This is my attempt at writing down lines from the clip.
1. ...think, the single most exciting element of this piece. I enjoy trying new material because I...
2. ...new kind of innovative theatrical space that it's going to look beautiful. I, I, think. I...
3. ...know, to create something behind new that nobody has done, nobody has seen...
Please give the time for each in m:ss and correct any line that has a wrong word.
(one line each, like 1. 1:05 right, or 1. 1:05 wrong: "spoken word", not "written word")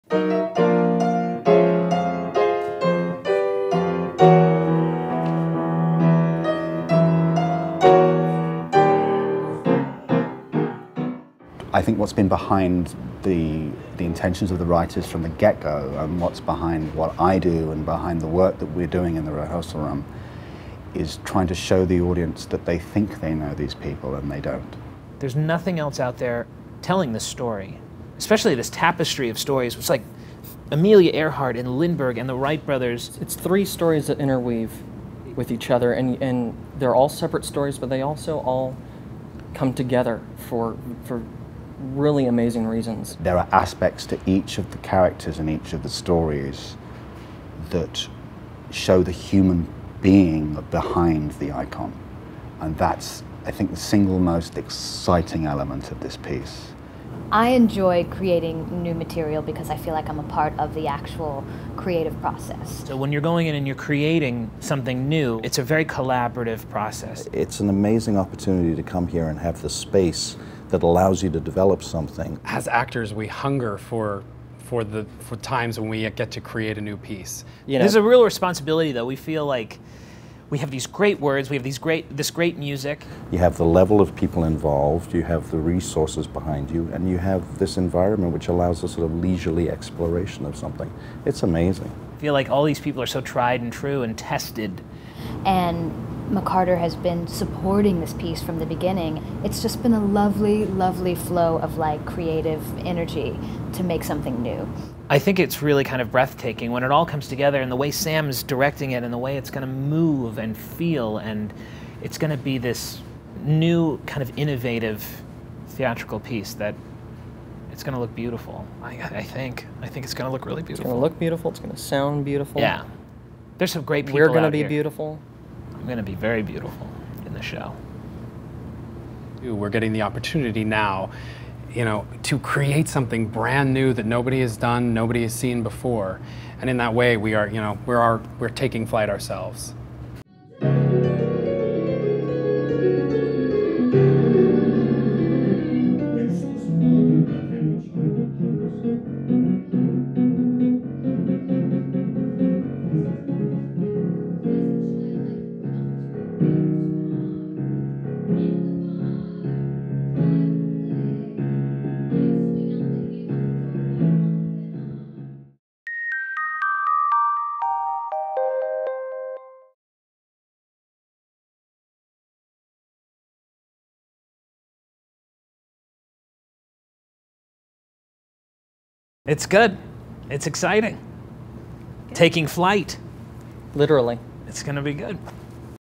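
1. 0:53 wrong: "creating", not "trying"
2. 1:53 wrong: "piece", not "space"
3. 2:11 wrong: "brand", not "behind".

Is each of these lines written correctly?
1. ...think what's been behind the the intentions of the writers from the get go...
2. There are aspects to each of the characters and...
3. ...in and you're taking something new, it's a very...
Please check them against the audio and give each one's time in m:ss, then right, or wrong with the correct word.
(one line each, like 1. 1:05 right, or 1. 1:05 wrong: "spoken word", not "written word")
1. 0:11 right
2. 0:43 right
3. 1:03 wrong: "creating", not "taking".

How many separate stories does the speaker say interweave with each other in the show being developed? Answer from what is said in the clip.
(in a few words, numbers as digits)
3.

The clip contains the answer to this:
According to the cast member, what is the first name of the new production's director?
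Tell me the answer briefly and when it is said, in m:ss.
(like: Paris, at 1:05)
Sam, at 1:47.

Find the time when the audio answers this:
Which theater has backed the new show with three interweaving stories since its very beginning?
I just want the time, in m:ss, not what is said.
1:36.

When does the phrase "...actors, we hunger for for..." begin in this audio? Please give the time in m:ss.
1:12.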